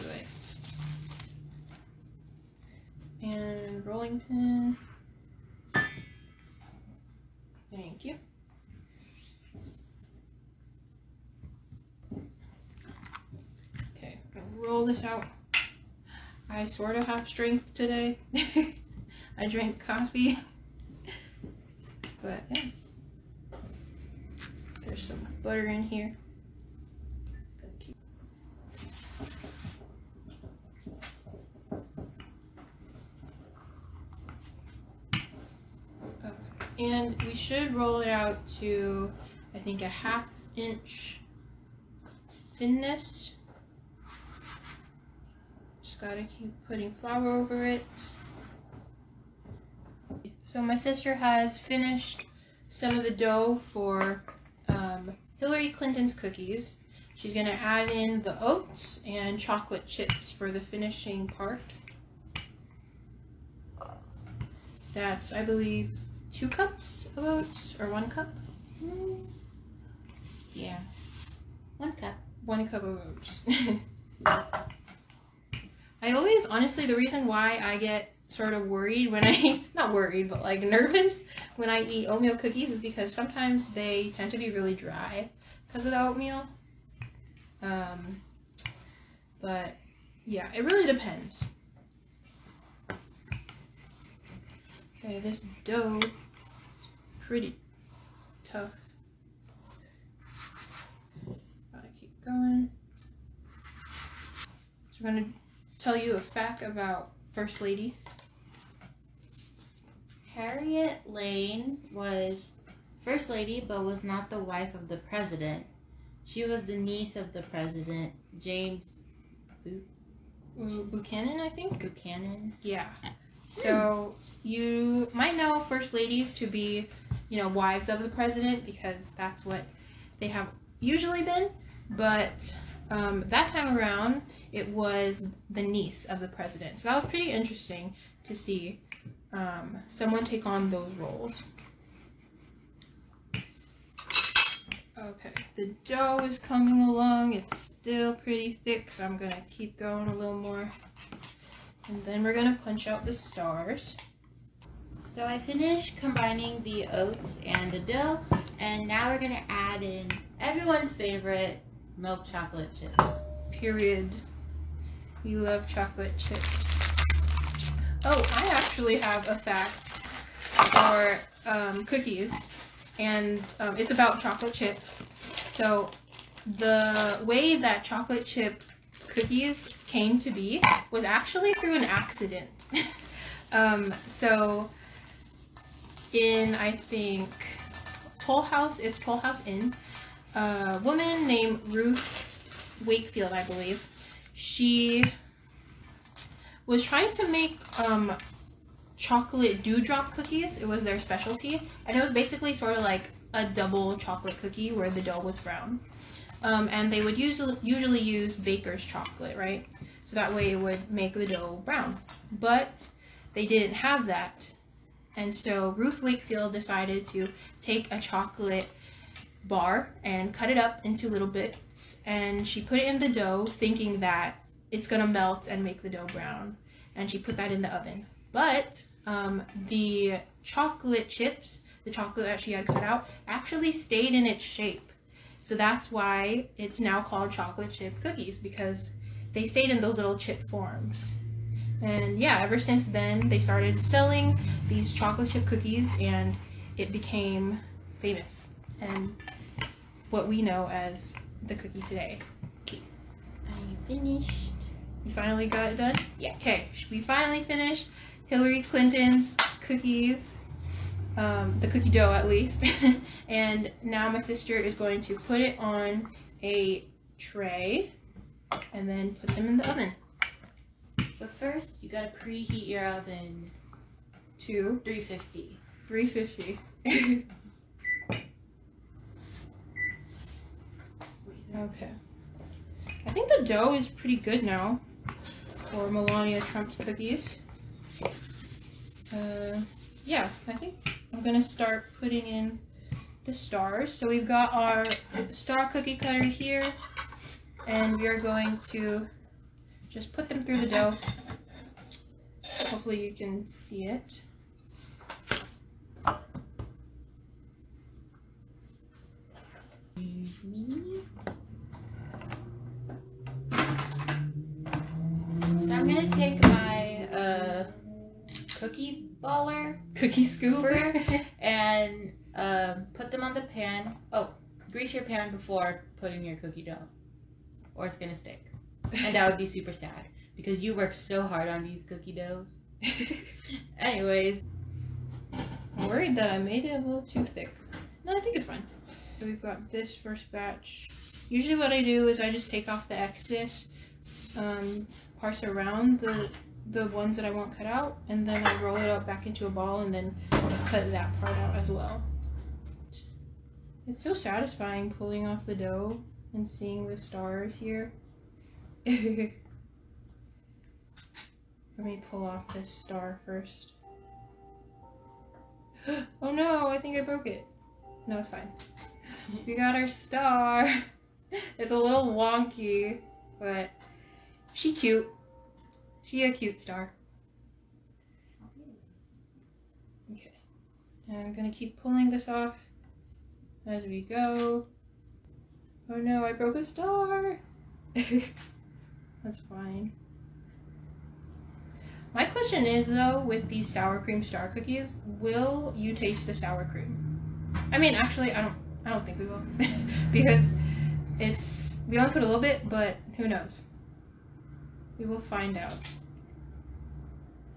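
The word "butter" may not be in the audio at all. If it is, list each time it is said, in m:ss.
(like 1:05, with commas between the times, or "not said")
0:25.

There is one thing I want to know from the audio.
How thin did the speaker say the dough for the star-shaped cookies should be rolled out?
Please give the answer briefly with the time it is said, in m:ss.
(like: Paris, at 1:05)
half inch, at 0:39.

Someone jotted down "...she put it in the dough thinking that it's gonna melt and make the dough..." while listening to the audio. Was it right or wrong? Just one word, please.
right.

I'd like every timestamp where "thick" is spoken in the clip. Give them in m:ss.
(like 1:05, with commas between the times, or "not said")
2:28, 5:37.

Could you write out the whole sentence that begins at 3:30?
So that way it would make the dough brown.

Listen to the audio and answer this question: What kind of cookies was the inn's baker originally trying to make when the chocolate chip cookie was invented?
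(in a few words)
chocolate dewdrop cookies.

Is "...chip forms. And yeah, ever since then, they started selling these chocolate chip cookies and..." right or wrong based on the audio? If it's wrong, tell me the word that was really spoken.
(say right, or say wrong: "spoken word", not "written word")
right.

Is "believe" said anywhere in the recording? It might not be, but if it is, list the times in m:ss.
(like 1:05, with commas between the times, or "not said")
1:05, 3:13.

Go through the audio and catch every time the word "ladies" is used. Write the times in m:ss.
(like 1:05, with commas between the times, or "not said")
1:47, 2:05.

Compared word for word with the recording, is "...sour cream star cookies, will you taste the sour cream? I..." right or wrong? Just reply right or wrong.
right.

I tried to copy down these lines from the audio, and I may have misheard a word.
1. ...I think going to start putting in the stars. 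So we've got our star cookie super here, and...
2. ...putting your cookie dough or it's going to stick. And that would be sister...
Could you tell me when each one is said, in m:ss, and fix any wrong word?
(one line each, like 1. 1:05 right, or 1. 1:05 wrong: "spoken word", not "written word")
1. 4:50 wrong: "cutter", not "super"
2. 5:25 wrong: "super", not "sister".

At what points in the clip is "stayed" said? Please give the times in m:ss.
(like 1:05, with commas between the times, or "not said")
3:53, 3:59.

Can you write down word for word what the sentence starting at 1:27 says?
Um, but yeah, it really depends.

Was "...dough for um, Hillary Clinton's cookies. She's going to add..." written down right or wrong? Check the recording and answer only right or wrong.
right.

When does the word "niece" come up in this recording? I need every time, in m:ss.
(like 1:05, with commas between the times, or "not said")
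1:56, 2:15.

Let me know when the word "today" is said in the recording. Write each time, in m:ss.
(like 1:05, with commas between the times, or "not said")
0:17, 4:11.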